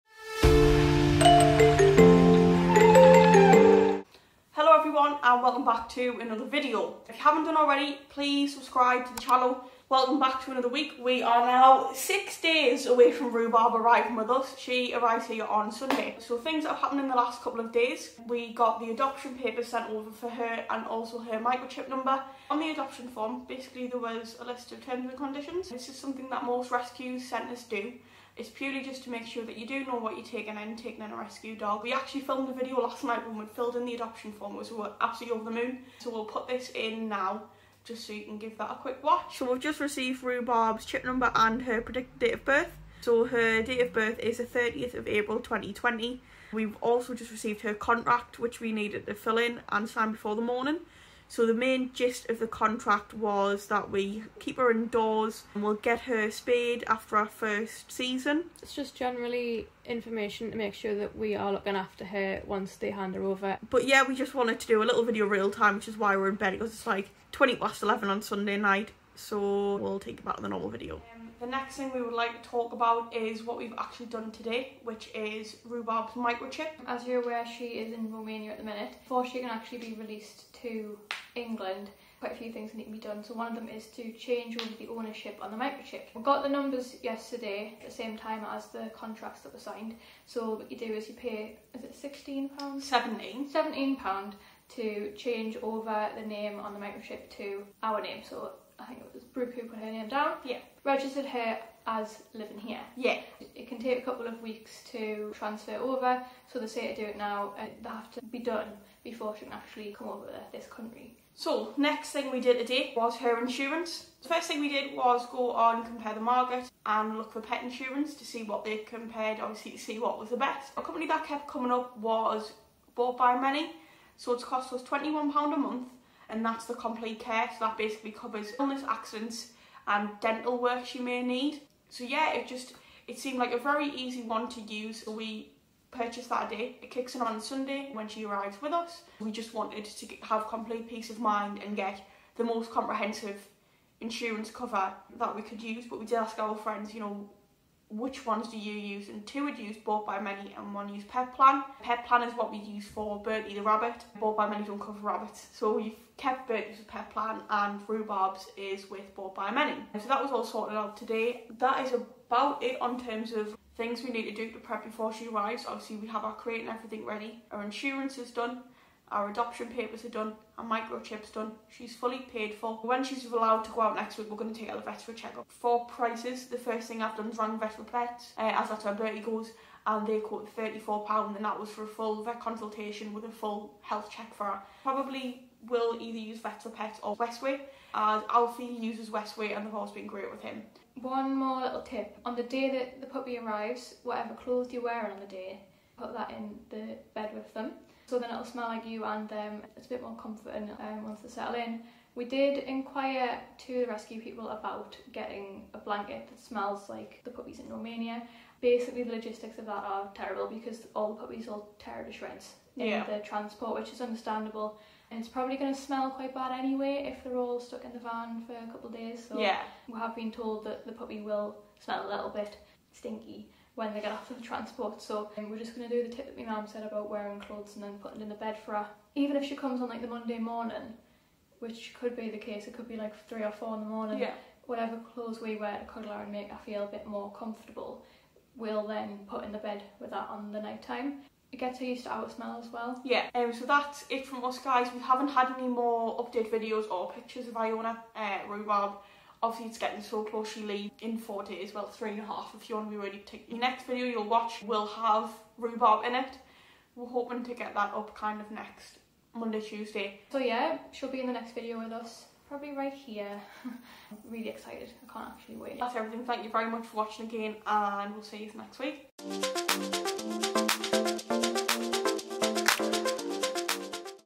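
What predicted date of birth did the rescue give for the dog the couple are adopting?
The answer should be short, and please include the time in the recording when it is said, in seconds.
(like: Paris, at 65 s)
30 April 2020, at 44 s.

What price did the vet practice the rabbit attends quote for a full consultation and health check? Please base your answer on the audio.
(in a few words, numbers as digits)
£34.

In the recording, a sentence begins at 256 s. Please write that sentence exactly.
We're hoping to get that up kind of next Monday, Tuesday.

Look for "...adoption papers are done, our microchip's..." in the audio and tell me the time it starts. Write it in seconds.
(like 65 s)
169 s.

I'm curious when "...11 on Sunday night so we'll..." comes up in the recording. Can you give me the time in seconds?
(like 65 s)
67 s.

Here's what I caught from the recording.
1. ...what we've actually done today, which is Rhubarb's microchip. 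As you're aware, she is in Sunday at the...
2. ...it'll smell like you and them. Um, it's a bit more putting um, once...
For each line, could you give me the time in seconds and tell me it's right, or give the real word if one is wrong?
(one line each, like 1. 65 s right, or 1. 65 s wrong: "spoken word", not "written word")
1. 73 s wrong: "Romania", not "Sunday"
2. 198 s wrong: "comforting", not "putting".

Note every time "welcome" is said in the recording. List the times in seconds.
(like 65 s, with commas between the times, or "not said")
5 s, 9 s.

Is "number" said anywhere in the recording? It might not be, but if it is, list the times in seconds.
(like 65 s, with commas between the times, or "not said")
21 s, 41 s, 86 s.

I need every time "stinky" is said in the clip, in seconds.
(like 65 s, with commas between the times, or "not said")
222 s.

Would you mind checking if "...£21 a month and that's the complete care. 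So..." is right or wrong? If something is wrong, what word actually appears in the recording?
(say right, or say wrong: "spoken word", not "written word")
right.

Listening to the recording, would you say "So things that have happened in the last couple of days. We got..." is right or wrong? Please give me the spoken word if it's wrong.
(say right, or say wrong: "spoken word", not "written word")
right.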